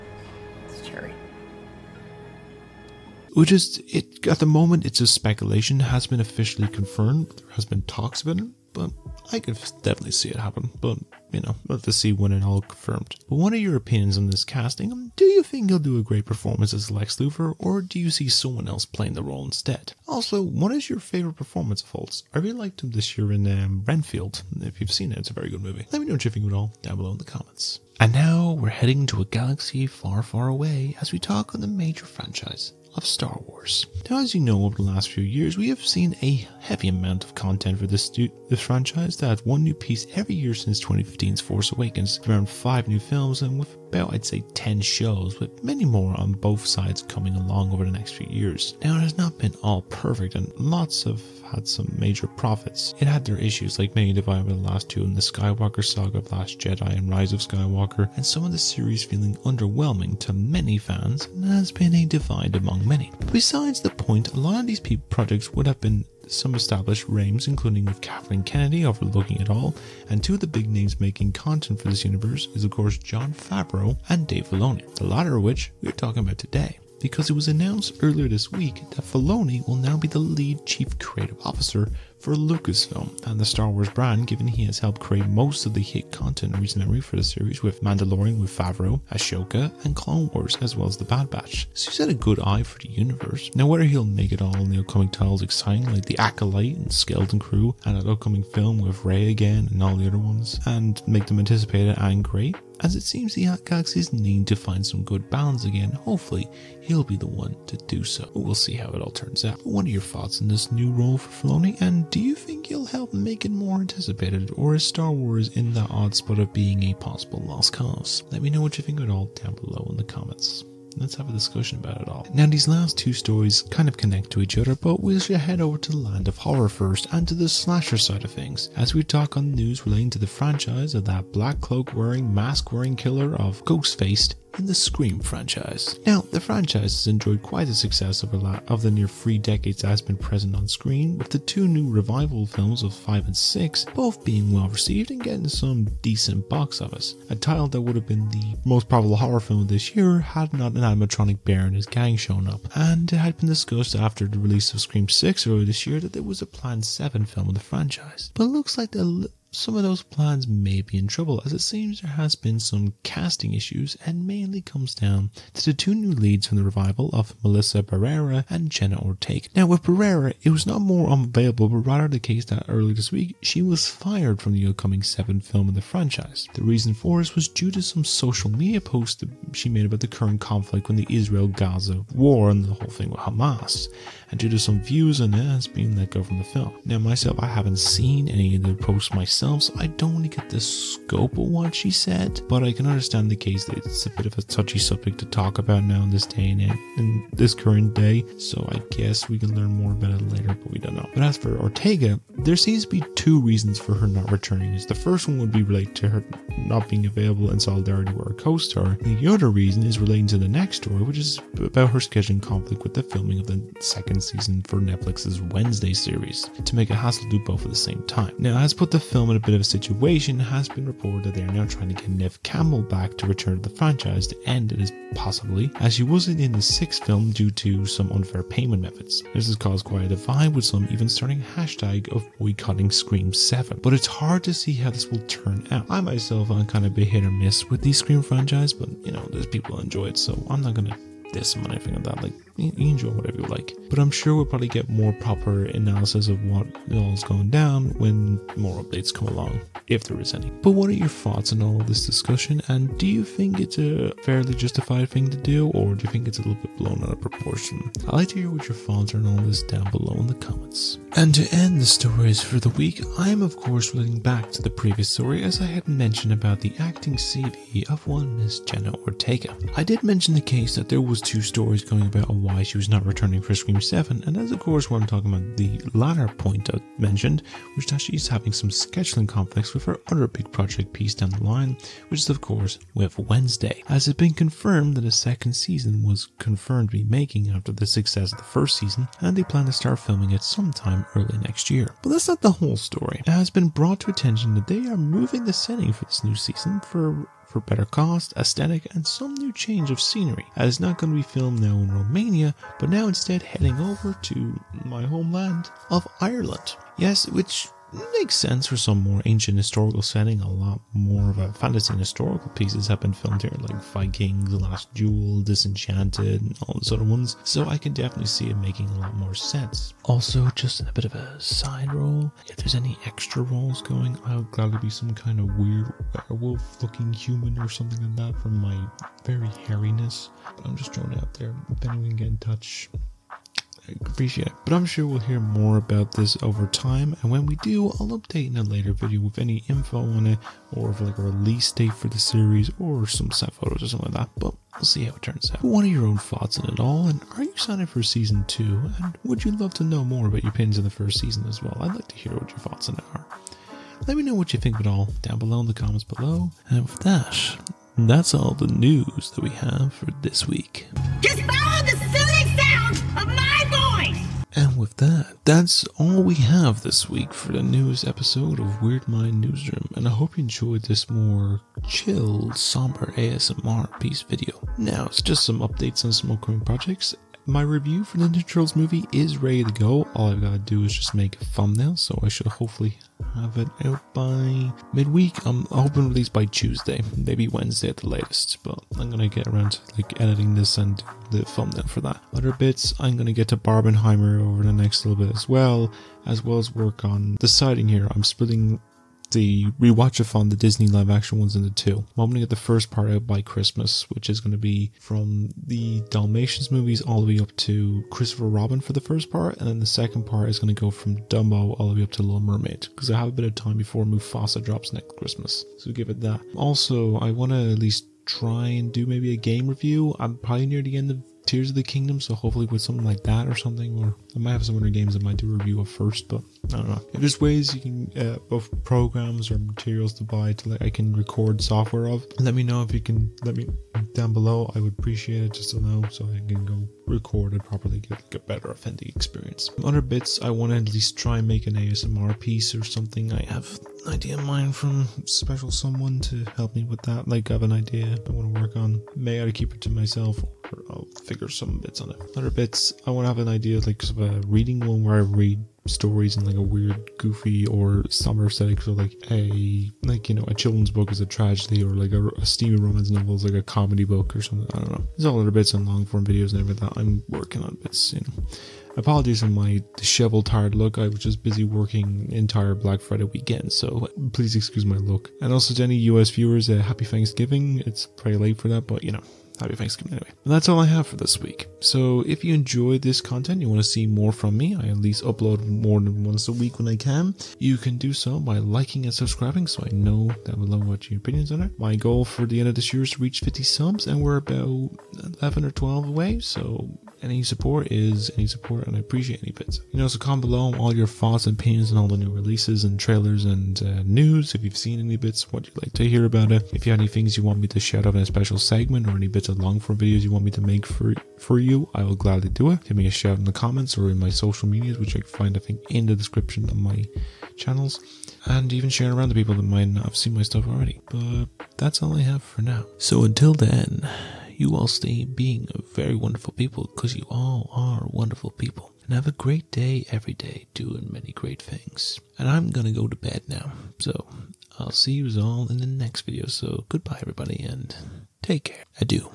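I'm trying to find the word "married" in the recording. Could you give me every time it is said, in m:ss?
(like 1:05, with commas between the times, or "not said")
not said.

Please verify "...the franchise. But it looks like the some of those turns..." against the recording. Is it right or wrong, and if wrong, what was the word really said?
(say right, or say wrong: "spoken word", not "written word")
wrong: "plans", not "turns".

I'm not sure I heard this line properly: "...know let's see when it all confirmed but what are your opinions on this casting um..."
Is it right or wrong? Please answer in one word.
right.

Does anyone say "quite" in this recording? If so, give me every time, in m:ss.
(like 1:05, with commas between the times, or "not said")
2:17, 3:49.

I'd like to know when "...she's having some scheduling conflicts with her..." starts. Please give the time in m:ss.
4:38.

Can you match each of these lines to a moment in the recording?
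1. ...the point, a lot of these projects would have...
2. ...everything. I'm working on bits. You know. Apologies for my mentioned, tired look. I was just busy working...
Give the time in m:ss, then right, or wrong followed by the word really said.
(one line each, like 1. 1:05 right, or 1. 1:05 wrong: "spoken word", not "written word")
1. 1:03 right
2. 7:46 wrong: "disheveled", not "mentioned".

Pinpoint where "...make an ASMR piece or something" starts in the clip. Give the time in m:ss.
7:21.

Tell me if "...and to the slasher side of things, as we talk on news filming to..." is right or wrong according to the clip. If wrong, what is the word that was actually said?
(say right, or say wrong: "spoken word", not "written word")
wrong: "relating", not "filming".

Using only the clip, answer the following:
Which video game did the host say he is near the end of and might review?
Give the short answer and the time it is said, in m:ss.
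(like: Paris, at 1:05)
Tears of the Kingdom, at 7:01.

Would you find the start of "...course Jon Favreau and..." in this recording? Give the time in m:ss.
1:12.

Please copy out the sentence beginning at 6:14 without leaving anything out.
Now, it's just some updates on some upcoming projects my review for the Ninja Turtles movie is ready to go.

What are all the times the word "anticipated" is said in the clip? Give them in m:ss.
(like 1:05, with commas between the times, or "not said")
1:41, 1:53.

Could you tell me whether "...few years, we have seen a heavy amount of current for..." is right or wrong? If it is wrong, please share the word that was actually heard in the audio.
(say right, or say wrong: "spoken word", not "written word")
wrong: "content", not "current".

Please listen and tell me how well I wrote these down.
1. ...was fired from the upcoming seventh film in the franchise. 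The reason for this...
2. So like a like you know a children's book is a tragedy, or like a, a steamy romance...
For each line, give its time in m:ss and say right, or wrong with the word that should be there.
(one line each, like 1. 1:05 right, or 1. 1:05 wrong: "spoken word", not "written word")
1. 2:53 right
2. 7:38 right.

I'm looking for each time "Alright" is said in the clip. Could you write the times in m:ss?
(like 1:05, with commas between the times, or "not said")
not said.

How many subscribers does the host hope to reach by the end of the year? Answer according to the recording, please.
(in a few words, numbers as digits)
50.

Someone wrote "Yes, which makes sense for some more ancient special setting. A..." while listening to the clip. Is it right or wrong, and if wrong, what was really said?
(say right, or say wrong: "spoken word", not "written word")
wrong: "historical", not "special".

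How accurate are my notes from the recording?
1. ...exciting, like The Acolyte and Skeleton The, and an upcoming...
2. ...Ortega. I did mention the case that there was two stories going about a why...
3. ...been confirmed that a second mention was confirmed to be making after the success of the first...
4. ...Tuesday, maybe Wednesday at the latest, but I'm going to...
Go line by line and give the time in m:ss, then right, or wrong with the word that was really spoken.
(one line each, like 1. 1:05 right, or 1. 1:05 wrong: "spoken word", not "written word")
1. 1:35 wrong: "Crew", not "The"
2. 4:29 right
3. 4:44 wrong: "season", not "mention"
4. 6:26 right.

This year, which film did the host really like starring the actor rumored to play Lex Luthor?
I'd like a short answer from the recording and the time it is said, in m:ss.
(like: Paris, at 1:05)
Renfield, at 0:23.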